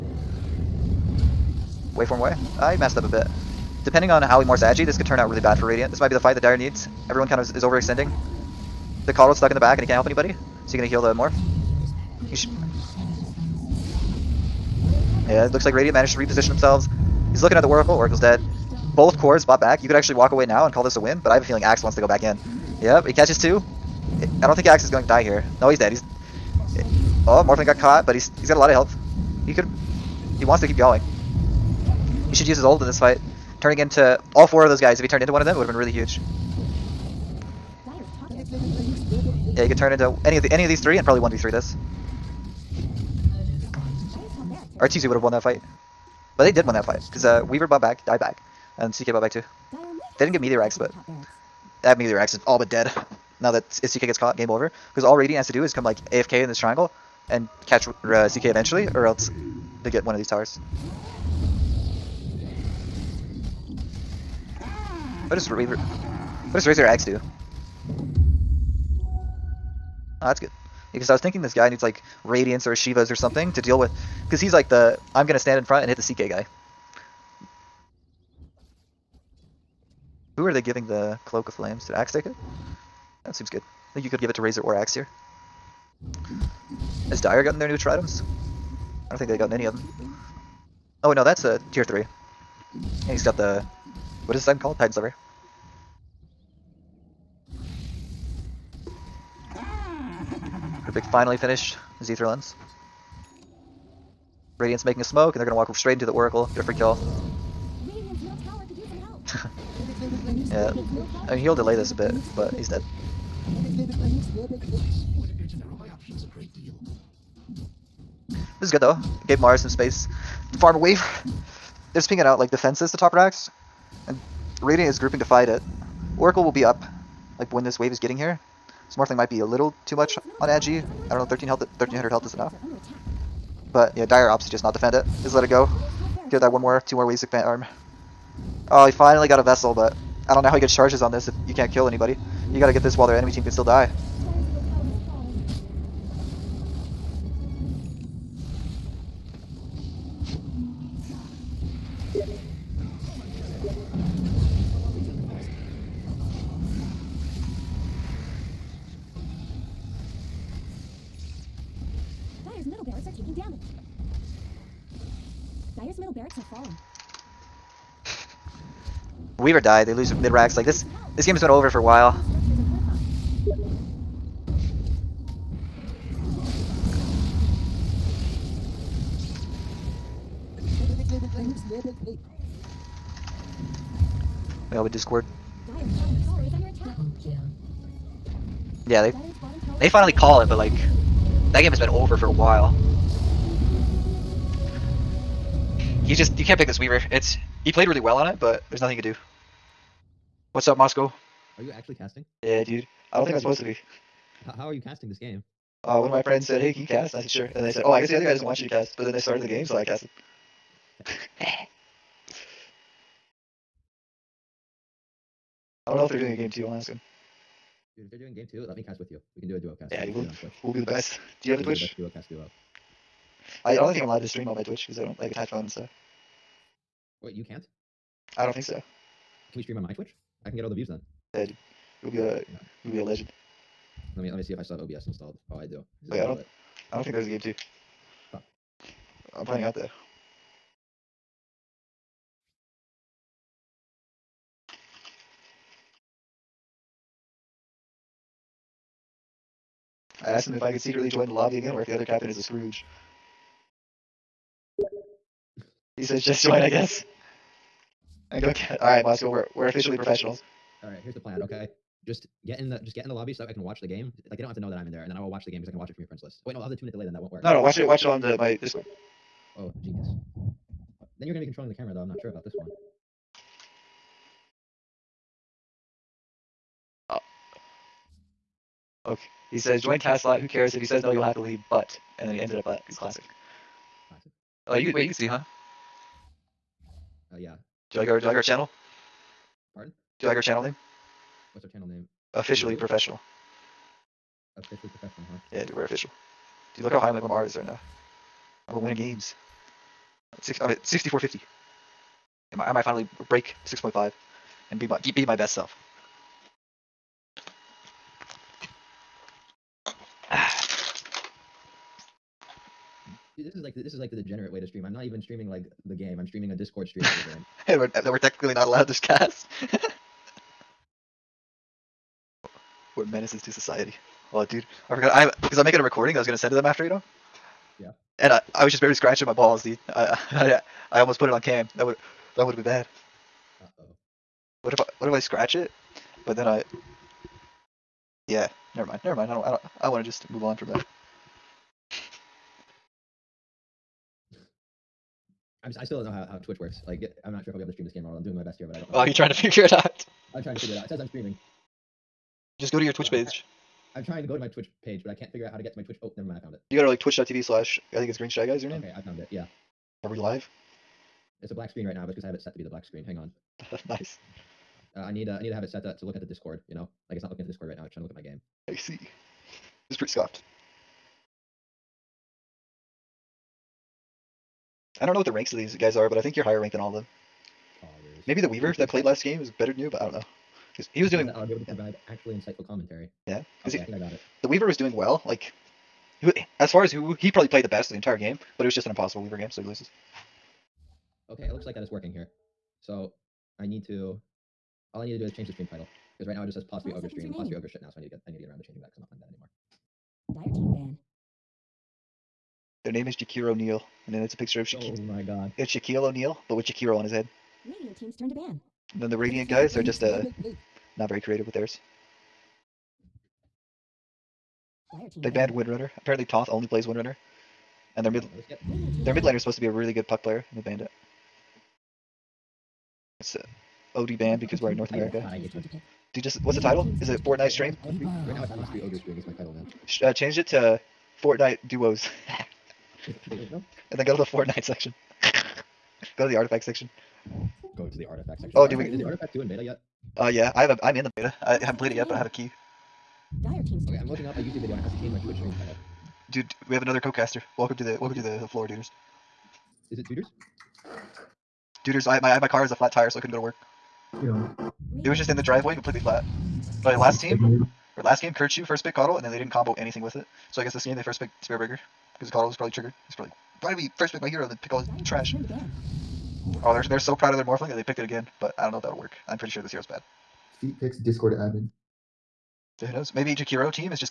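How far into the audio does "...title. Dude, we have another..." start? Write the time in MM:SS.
07:25.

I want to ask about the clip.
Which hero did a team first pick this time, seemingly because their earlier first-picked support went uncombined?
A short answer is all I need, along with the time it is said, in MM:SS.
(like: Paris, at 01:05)
Spirit Breaker, at 07:41.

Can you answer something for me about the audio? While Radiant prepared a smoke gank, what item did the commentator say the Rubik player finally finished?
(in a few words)
Aether Lens.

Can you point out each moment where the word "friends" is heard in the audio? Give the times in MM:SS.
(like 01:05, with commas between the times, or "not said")
03:26, 04:26.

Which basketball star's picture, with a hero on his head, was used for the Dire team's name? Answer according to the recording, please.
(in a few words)
Shaquille O'Neal.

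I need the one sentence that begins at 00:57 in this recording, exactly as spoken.
And catch uh, CK eventually, or else they get one of these towers.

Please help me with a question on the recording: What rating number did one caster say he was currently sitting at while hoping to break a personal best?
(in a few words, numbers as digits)
6450.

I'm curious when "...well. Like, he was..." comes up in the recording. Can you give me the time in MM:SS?
06:24.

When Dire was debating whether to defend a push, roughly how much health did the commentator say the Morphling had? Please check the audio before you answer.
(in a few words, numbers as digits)
1300.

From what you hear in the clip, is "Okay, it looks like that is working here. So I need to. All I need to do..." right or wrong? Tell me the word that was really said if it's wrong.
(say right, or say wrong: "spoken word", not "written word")
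right.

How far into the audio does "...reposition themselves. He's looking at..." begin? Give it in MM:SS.
00:16.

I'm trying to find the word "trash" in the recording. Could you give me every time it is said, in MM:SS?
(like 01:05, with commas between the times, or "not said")
07:45.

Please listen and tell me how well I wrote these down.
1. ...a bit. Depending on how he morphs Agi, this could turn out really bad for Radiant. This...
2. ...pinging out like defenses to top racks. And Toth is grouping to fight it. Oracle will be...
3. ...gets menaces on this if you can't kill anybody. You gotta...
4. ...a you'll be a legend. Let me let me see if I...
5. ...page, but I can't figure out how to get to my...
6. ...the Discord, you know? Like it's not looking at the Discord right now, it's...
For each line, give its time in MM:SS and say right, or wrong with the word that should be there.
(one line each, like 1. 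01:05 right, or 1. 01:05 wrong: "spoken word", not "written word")
1. 00:03 right
2. 02:02 wrong: "Radiant", not "Toth"
3. 02:20 wrong: "charges", not "menaces"
4. 03:52 right
5. 05:54 right
6. 06:06 right.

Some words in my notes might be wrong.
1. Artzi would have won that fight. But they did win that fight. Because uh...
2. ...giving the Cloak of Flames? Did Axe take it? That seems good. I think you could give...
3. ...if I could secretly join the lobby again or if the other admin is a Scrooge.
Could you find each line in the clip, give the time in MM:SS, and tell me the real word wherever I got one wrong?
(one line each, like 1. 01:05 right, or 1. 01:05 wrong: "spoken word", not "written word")
1. 00:44 right
2. 01:20 right
3. 04:10 wrong: "captain", not "admin".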